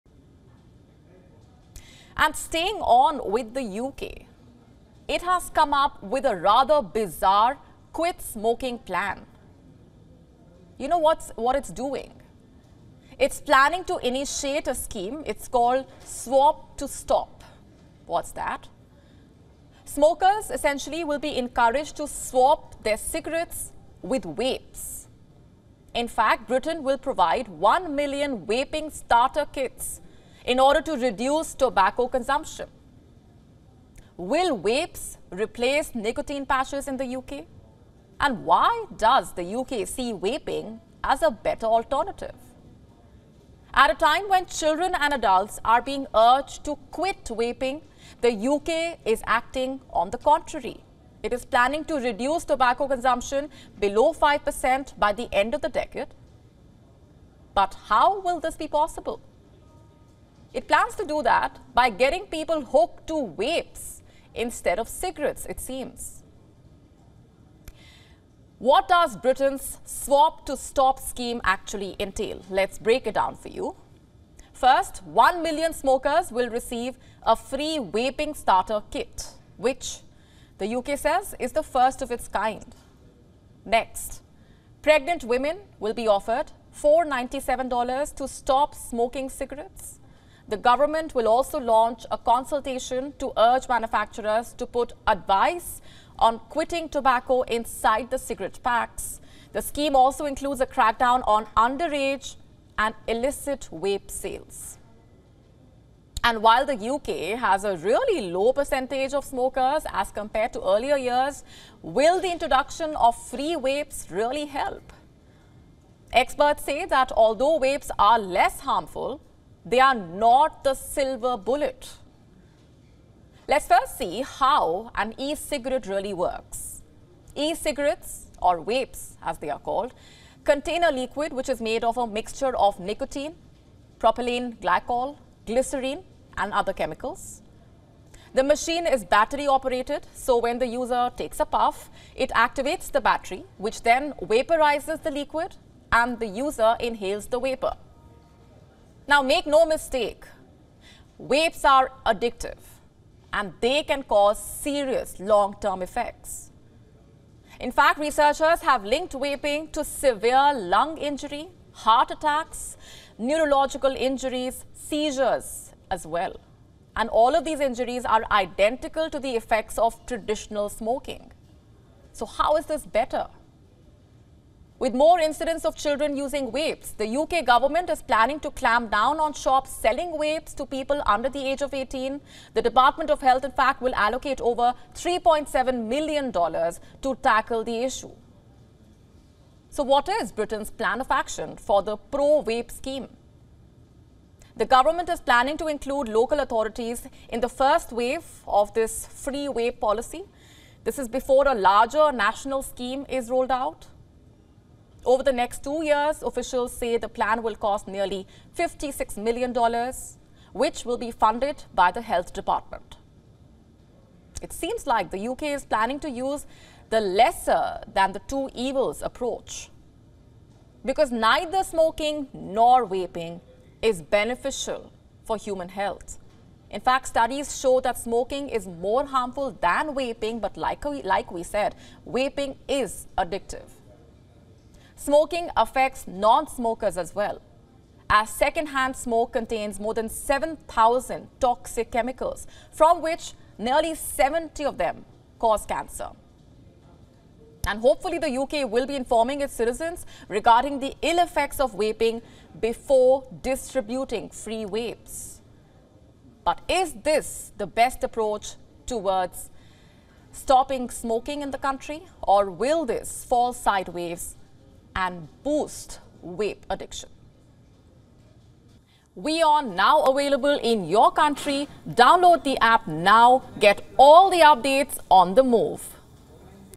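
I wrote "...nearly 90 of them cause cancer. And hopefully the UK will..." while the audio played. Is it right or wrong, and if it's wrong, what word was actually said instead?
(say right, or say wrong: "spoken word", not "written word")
wrong: "70", not "90".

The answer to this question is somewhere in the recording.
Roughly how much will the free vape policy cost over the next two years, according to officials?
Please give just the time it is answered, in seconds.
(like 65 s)
208 s.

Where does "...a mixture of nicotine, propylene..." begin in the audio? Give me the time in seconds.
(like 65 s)
131 s.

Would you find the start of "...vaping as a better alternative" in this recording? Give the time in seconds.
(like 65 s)
40 s.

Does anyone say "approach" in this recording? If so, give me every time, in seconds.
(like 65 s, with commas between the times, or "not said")
219 s, 258 s.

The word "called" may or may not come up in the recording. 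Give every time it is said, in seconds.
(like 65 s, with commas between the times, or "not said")
15 s, 129 s.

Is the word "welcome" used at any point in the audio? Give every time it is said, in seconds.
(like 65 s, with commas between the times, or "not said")
not said.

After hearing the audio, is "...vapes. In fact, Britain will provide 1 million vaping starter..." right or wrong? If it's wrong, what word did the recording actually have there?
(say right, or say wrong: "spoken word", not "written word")
right.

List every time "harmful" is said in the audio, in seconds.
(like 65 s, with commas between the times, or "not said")
118 s, 229 s.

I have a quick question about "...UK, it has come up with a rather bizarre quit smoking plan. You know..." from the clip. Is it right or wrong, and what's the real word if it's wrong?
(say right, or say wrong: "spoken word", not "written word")
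right.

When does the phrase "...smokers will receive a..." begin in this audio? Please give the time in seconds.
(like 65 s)
75 s.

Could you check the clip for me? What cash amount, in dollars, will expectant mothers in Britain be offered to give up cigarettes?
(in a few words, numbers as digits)
$497.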